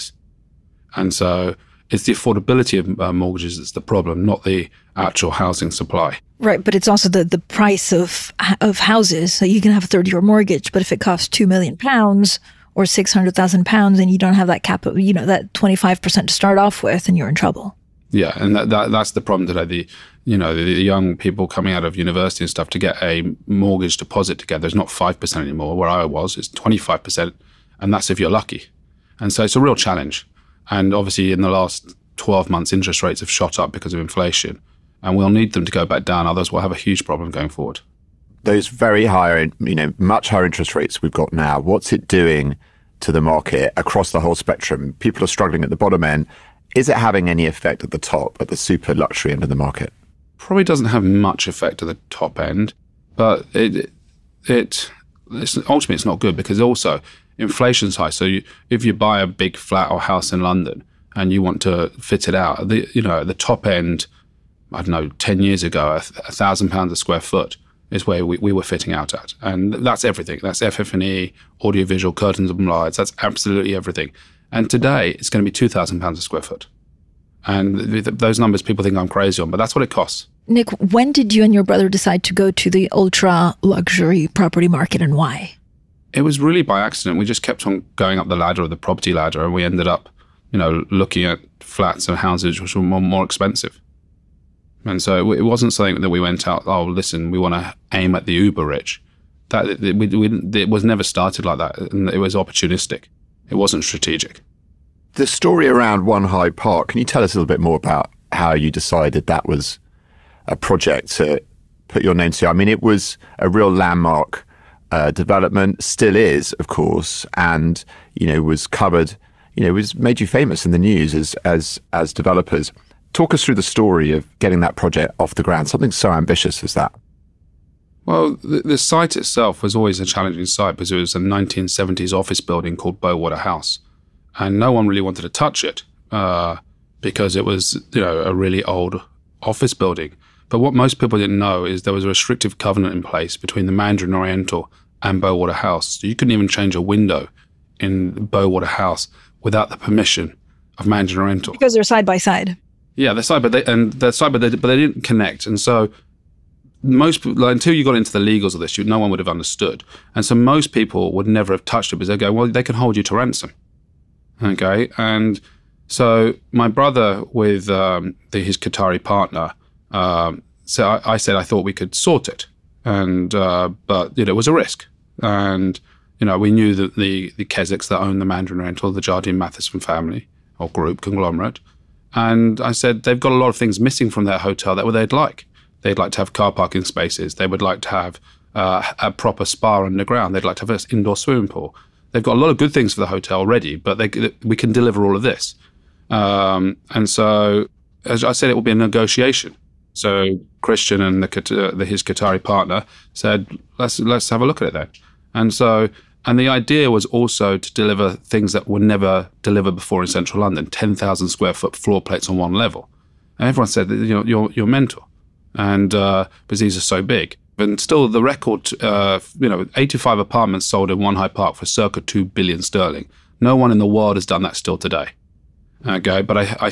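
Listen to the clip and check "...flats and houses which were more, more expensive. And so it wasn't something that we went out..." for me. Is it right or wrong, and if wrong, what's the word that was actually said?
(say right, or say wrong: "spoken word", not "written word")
right.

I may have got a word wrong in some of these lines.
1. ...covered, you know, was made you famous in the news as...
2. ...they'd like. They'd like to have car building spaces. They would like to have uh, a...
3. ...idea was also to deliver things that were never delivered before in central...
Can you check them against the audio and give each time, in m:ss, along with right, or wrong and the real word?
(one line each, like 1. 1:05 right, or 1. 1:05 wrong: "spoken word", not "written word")
1. 1:58 right
2. 3:04 wrong: "parking", not "building"
3. 3:26 right.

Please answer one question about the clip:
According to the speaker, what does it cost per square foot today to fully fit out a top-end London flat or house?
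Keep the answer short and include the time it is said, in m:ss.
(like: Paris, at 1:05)
£2,000, at 1:15.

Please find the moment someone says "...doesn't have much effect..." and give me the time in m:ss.
0:50.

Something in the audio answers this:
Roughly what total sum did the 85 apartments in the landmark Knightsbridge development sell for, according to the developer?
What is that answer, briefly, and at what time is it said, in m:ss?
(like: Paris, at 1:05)
2 billion sterling, at 3:42.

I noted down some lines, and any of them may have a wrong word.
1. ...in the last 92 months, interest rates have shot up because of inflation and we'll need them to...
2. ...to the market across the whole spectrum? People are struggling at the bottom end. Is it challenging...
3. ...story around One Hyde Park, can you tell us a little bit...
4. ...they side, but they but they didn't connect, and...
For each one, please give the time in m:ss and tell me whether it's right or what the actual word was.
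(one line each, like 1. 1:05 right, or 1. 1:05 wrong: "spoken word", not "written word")
1. 0:31 wrong: "12", not "92"
2. 0:43 wrong: "having", not "challenging"
3. 1:45 right
4. 2:33 right.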